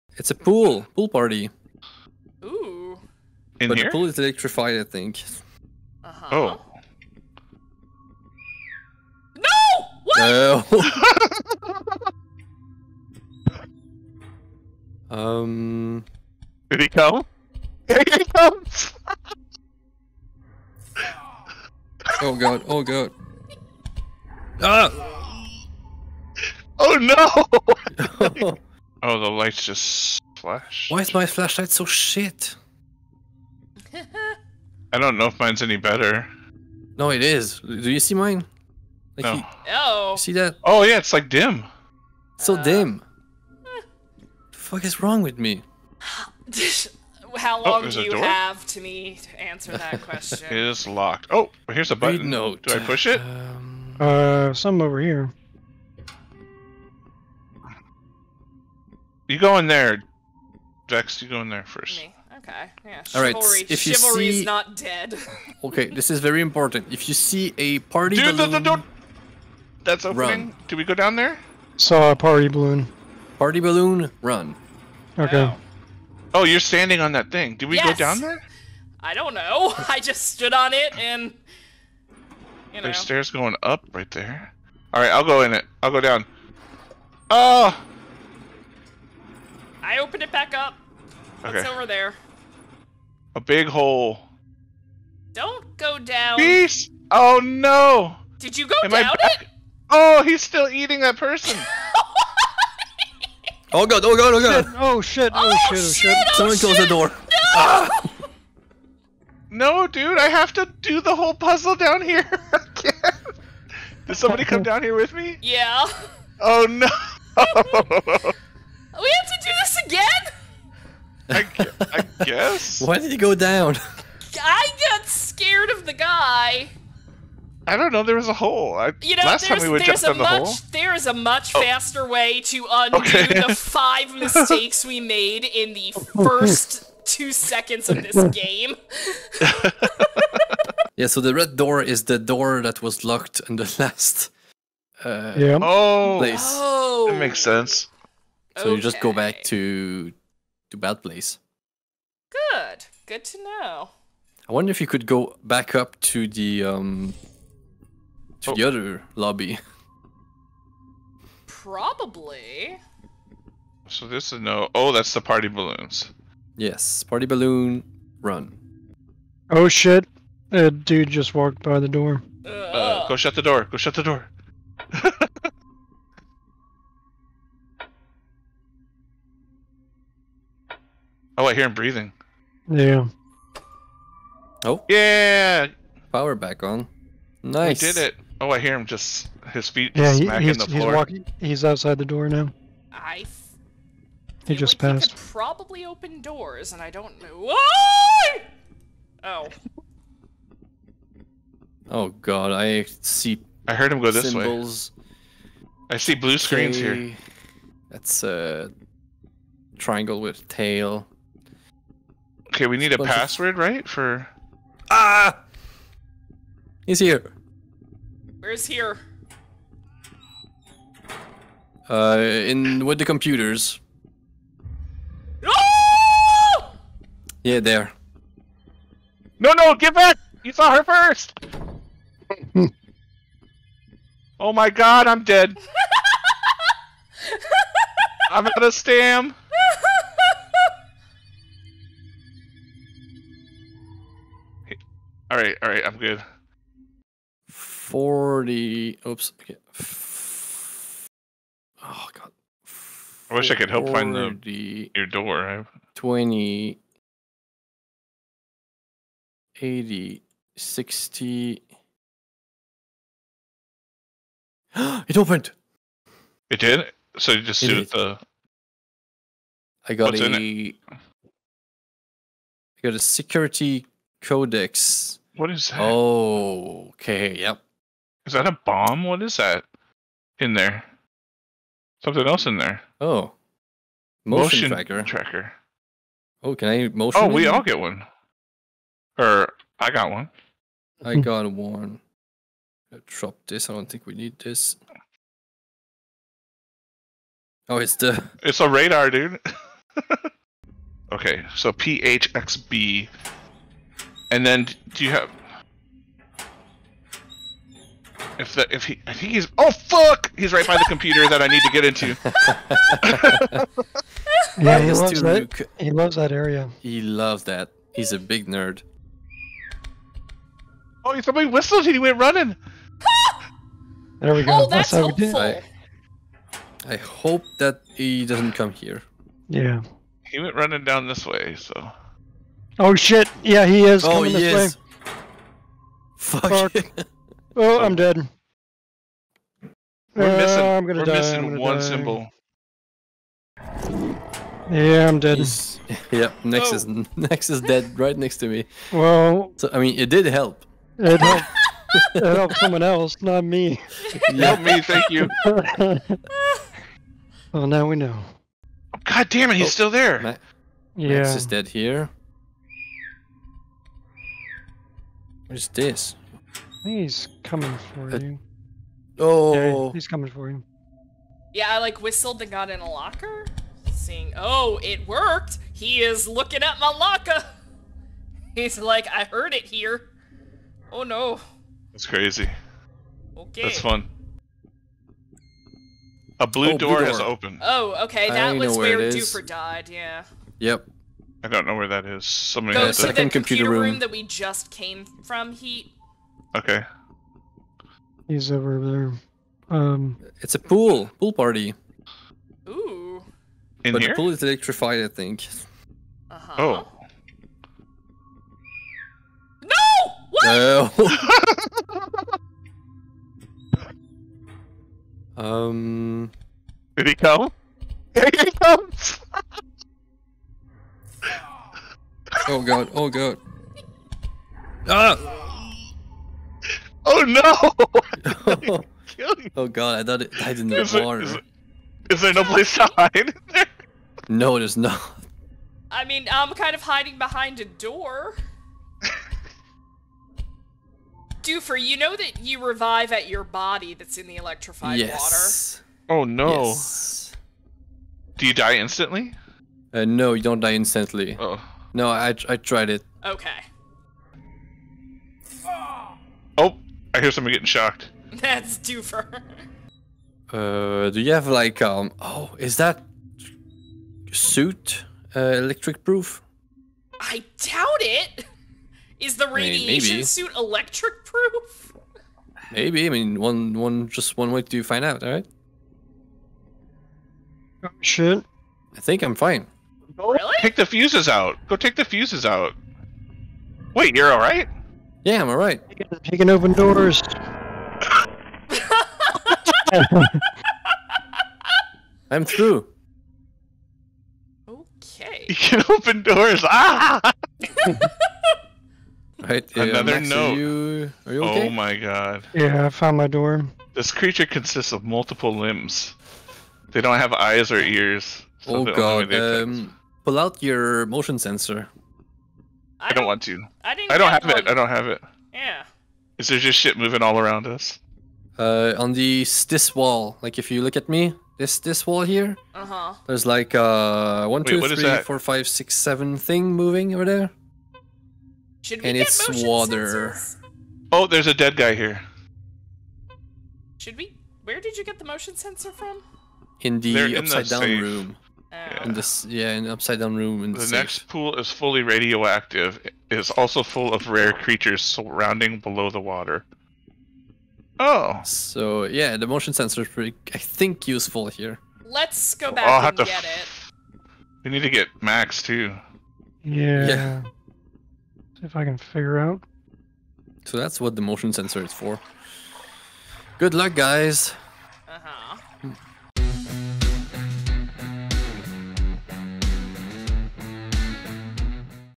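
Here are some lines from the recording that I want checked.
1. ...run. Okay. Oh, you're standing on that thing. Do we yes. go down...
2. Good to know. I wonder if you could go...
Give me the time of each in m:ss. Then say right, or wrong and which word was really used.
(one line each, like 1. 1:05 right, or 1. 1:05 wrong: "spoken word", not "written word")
1. 1:14 right
2. 2:33 right.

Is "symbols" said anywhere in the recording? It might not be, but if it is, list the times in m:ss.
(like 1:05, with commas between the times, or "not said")
3:24, 5:41.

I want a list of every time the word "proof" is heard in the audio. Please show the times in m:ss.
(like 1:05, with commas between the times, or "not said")
7:46, 7:51.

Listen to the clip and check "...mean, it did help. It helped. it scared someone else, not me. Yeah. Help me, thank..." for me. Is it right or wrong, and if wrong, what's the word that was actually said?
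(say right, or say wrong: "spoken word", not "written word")
wrong: "helped", not "scared".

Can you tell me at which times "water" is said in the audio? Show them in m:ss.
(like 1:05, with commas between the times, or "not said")
7:10, 7:26, 8:49, 9:06.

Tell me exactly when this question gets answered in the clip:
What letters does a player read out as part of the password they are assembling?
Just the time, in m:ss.
5:01.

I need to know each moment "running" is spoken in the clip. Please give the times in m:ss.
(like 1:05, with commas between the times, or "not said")
5:22, 5:30.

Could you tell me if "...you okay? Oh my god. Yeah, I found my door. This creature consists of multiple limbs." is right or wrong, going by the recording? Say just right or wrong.
right.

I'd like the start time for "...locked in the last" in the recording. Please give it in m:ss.
2:23.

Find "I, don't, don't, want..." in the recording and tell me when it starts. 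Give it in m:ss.
8:32.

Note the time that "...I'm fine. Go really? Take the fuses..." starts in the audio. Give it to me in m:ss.
7:59.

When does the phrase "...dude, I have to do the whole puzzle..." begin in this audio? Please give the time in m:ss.
1:49.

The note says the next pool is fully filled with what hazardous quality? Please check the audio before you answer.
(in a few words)
Radioactive.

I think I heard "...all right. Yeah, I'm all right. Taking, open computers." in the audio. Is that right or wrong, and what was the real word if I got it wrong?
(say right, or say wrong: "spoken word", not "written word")
wrong: "doors", not "computers".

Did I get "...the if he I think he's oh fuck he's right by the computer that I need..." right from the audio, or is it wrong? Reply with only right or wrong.
right.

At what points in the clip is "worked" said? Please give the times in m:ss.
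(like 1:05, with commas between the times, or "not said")
6:15.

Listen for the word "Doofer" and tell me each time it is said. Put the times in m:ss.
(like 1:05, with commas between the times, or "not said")
7:21, 7:38.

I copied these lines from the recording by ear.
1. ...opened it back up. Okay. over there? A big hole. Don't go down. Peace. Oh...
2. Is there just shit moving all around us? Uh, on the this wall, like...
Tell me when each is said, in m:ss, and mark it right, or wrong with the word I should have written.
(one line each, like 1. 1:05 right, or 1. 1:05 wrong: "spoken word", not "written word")
1. 1:29 right
2. 8:36 right.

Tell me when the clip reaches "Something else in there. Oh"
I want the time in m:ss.
4:42.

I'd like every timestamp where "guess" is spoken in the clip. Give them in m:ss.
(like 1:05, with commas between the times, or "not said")
2:02.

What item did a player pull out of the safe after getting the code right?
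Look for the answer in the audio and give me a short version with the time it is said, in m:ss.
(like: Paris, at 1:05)
Security codex, at 4:32.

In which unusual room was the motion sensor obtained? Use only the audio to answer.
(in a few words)
Upside down room.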